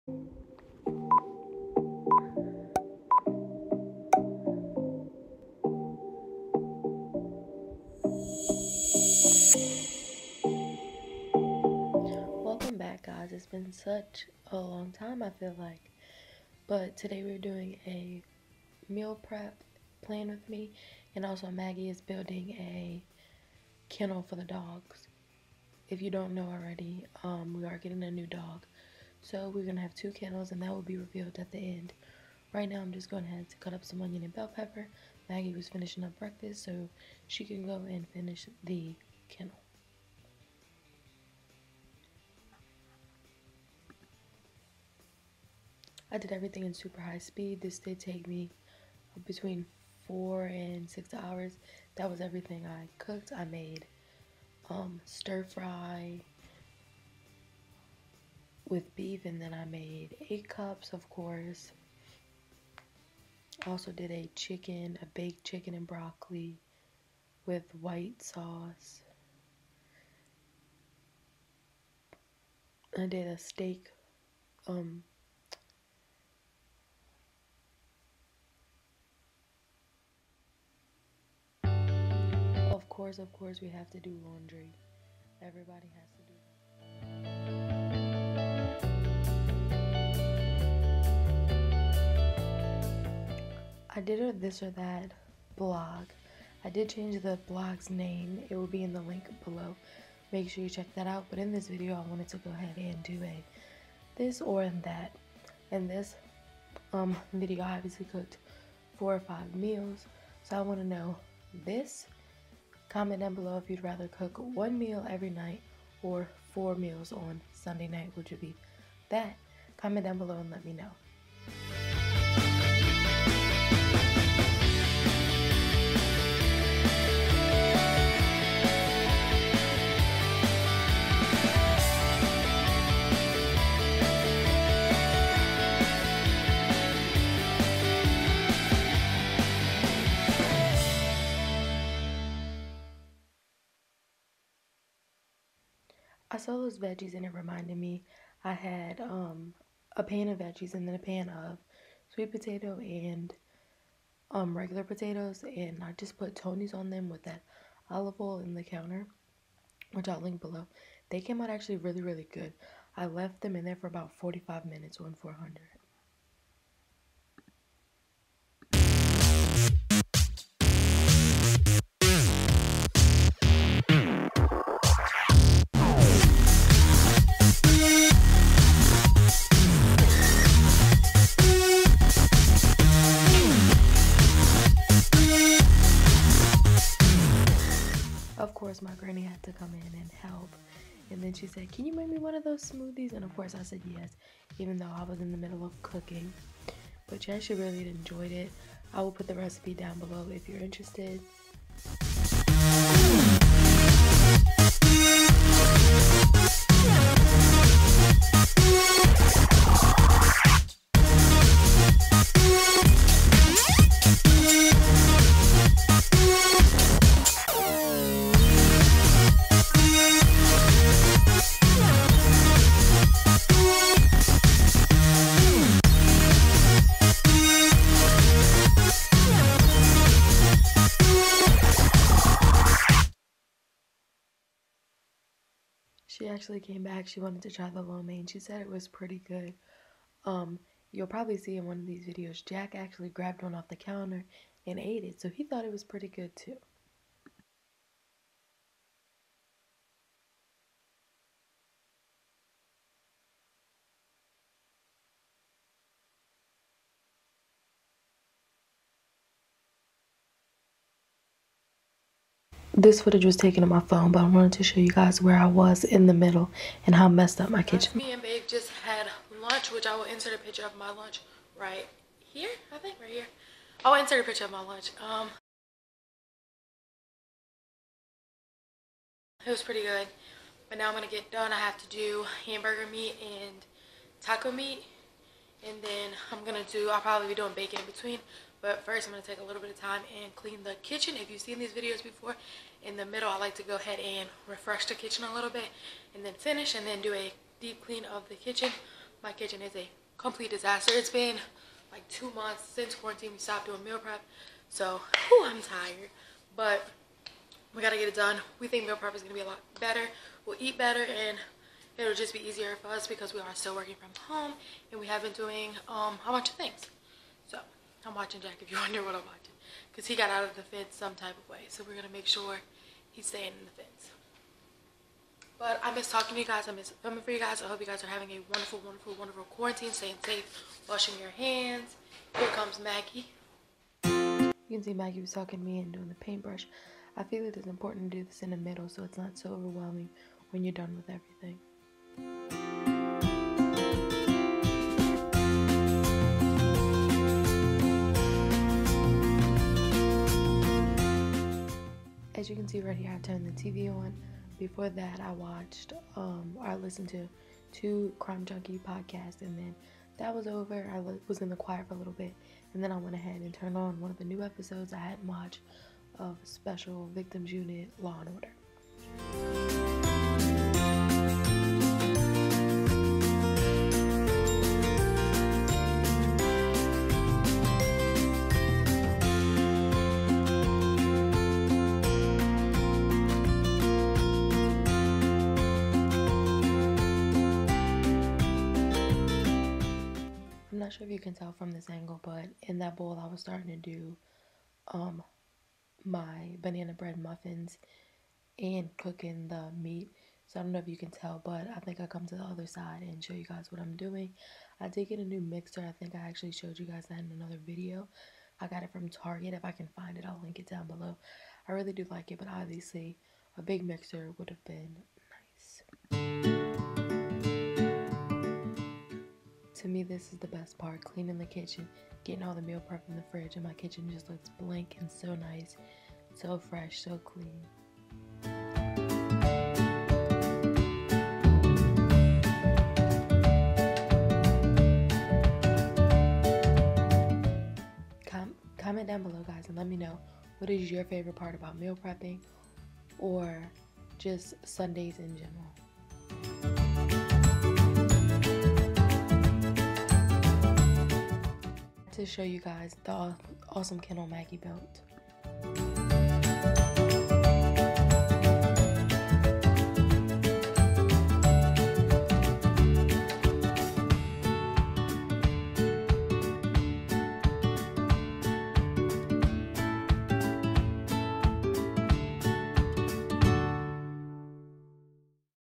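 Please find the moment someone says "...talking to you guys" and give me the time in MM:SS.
05:26.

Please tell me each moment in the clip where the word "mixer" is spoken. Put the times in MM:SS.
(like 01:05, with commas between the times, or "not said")
06:45, 06:53.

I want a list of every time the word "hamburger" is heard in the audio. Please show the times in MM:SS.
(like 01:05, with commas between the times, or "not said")
04:42.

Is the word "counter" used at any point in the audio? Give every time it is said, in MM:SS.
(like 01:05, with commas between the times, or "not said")
02:38, 04:03.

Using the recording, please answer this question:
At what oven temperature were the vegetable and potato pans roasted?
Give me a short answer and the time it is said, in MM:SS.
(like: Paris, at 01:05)
400, at 02:45.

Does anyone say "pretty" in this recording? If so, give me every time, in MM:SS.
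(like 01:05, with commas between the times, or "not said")
03:58, 04:05, 04:39.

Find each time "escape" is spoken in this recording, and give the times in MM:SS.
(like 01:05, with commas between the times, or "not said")
not said.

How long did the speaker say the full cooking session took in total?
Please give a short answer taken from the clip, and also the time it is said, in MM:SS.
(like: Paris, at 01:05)
Between 4 and 6 hours, at 00:49.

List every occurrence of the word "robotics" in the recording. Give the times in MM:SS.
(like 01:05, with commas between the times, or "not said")
not said.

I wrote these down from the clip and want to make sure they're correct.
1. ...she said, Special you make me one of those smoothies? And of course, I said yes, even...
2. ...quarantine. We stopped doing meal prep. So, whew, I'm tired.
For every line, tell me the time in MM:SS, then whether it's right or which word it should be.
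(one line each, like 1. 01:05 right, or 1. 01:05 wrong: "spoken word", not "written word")
1. 03:11 wrong: "Can", not "Special"
2. 05:02 right.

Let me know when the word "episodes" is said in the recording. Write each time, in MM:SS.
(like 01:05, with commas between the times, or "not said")
06:04.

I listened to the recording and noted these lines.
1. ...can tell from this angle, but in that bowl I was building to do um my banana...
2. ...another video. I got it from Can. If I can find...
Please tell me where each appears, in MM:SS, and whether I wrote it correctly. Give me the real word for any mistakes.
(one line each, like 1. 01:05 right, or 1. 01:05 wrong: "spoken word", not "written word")
1. 06:31 wrong: "starting", not "building"
2. 06:47 wrong: "Target", not "Can".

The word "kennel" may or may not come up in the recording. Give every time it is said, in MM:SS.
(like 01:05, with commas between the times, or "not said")
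00:23, 00:30, 00:39.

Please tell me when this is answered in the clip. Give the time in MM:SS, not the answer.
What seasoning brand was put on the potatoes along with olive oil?
02:36.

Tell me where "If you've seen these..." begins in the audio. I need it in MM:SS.
04:51.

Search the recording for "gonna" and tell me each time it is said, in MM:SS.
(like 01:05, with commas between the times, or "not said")
04:40.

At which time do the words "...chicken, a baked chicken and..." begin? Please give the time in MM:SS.
01:04.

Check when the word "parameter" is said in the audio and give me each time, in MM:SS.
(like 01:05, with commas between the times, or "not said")
not said.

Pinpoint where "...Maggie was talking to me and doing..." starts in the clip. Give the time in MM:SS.
05:34.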